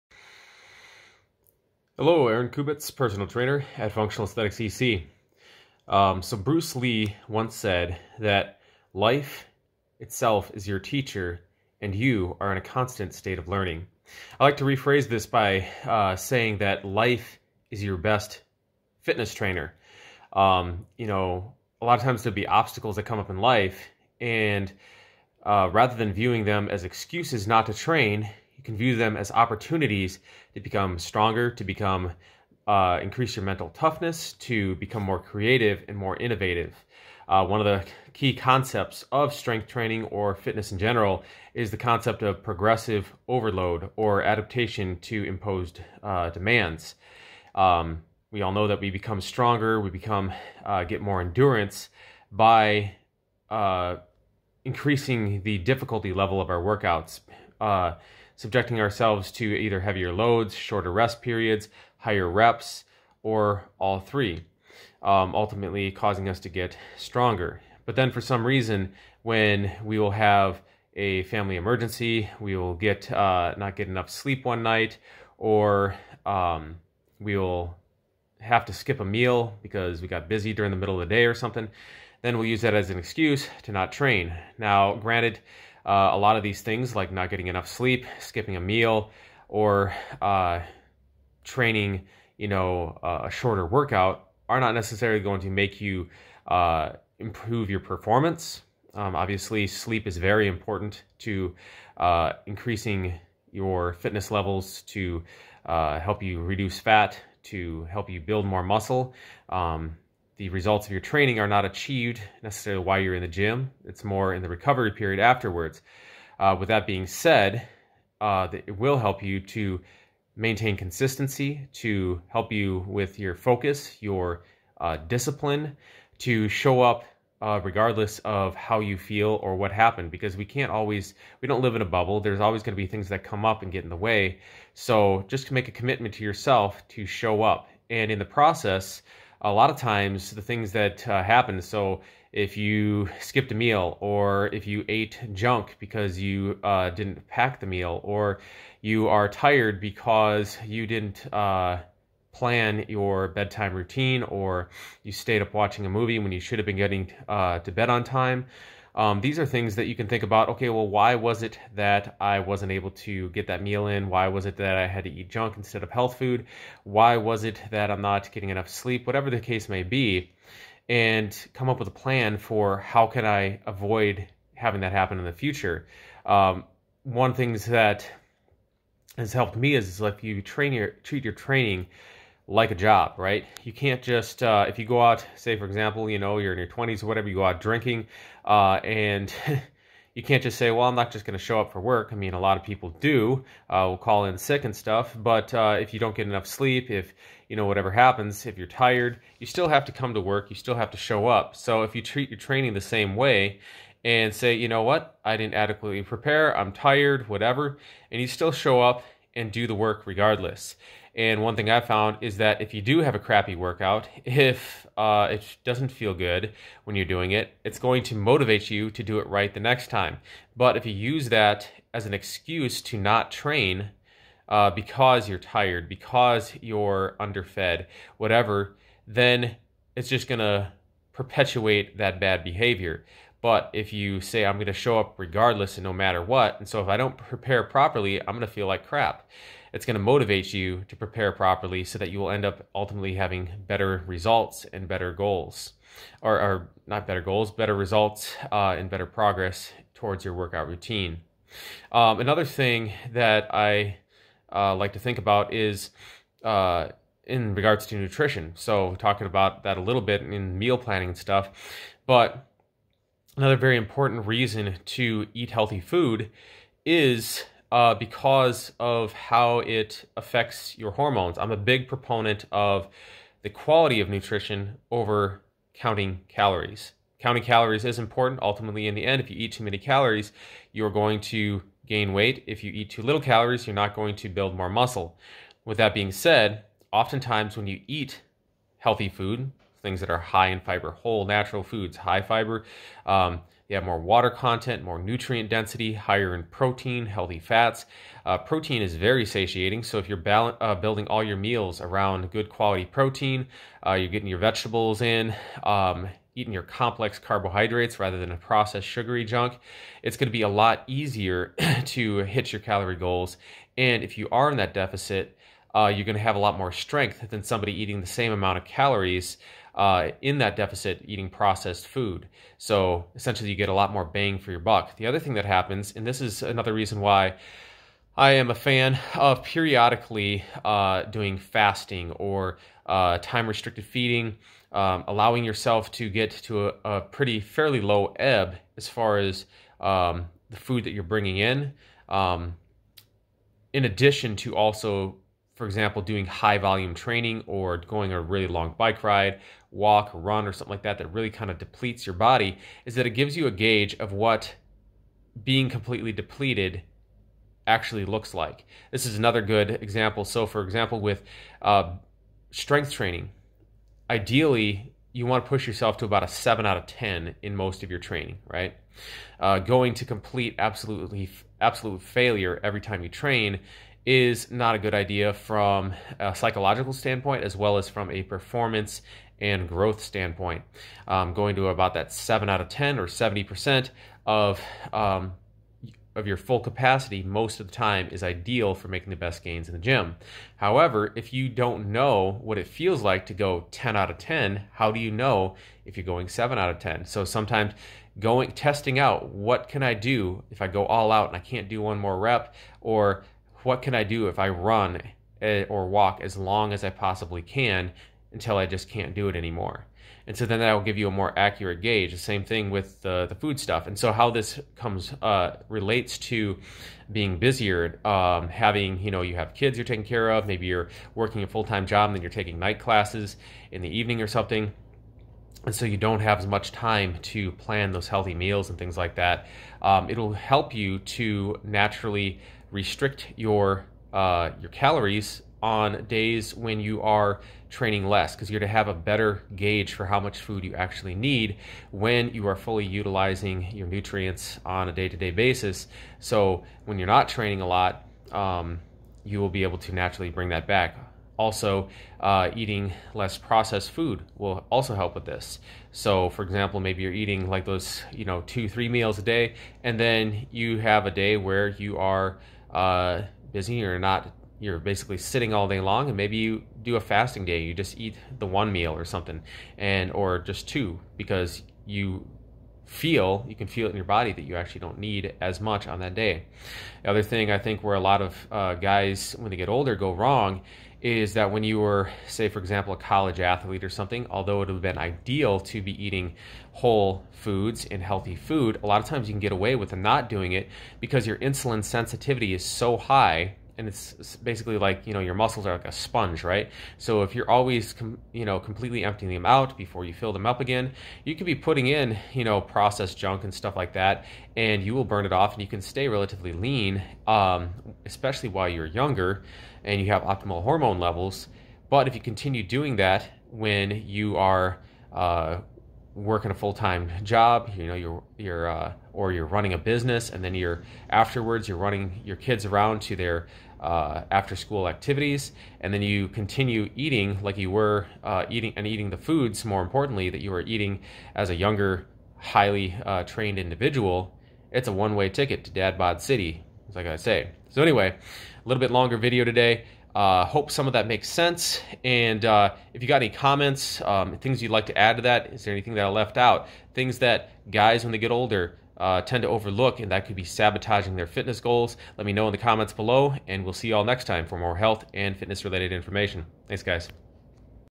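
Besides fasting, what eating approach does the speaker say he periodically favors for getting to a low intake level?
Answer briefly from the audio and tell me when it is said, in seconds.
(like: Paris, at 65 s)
time restricted feeding, at 333 s.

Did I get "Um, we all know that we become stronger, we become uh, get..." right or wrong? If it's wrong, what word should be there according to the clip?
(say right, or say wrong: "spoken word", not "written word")
right.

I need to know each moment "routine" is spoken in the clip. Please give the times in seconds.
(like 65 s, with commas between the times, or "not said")
153 s, 250 s.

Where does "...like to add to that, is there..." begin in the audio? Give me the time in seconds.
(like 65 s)
544 s.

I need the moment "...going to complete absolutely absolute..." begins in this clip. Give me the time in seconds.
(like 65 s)
369 s.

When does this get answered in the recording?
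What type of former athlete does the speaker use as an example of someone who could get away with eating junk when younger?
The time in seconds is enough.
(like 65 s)
482 s.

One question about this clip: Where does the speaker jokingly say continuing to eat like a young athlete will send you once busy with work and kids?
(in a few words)
dad bod city.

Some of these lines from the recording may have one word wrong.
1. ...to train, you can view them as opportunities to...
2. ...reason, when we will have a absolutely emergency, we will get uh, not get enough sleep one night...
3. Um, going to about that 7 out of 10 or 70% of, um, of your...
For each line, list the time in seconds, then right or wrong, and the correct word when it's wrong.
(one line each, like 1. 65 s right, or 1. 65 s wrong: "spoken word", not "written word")
1. 27 s right
2. 68 s wrong: "family", not "absolutely"
3. 381 s right.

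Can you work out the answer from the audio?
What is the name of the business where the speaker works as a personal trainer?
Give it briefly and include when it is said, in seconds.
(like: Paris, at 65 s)
Functional Aesthetics EC, at 3 s.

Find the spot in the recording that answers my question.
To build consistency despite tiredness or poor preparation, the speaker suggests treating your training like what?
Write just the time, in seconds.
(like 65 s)
182 s.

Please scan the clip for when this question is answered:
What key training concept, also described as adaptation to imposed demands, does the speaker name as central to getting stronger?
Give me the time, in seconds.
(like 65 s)
42 s.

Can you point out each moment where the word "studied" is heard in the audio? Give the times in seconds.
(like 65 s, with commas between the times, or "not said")
not said.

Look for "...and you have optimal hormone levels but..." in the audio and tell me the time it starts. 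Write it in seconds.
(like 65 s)
509 s.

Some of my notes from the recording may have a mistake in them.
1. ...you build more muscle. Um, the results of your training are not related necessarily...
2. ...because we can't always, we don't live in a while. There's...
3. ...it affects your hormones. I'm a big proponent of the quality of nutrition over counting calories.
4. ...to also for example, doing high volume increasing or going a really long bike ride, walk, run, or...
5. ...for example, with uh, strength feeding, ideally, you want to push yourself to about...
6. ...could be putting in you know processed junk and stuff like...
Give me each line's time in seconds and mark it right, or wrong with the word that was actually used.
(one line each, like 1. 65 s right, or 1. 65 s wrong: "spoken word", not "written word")
1. 108 s wrong: "achieved", not "related"
2. 130 s wrong: "bubble", not "while"
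3. 269 s right
4. 344 s wrong: "training", not "increasing"
5. 360 s wrong: "training", not "feeding"
6. 501 s right.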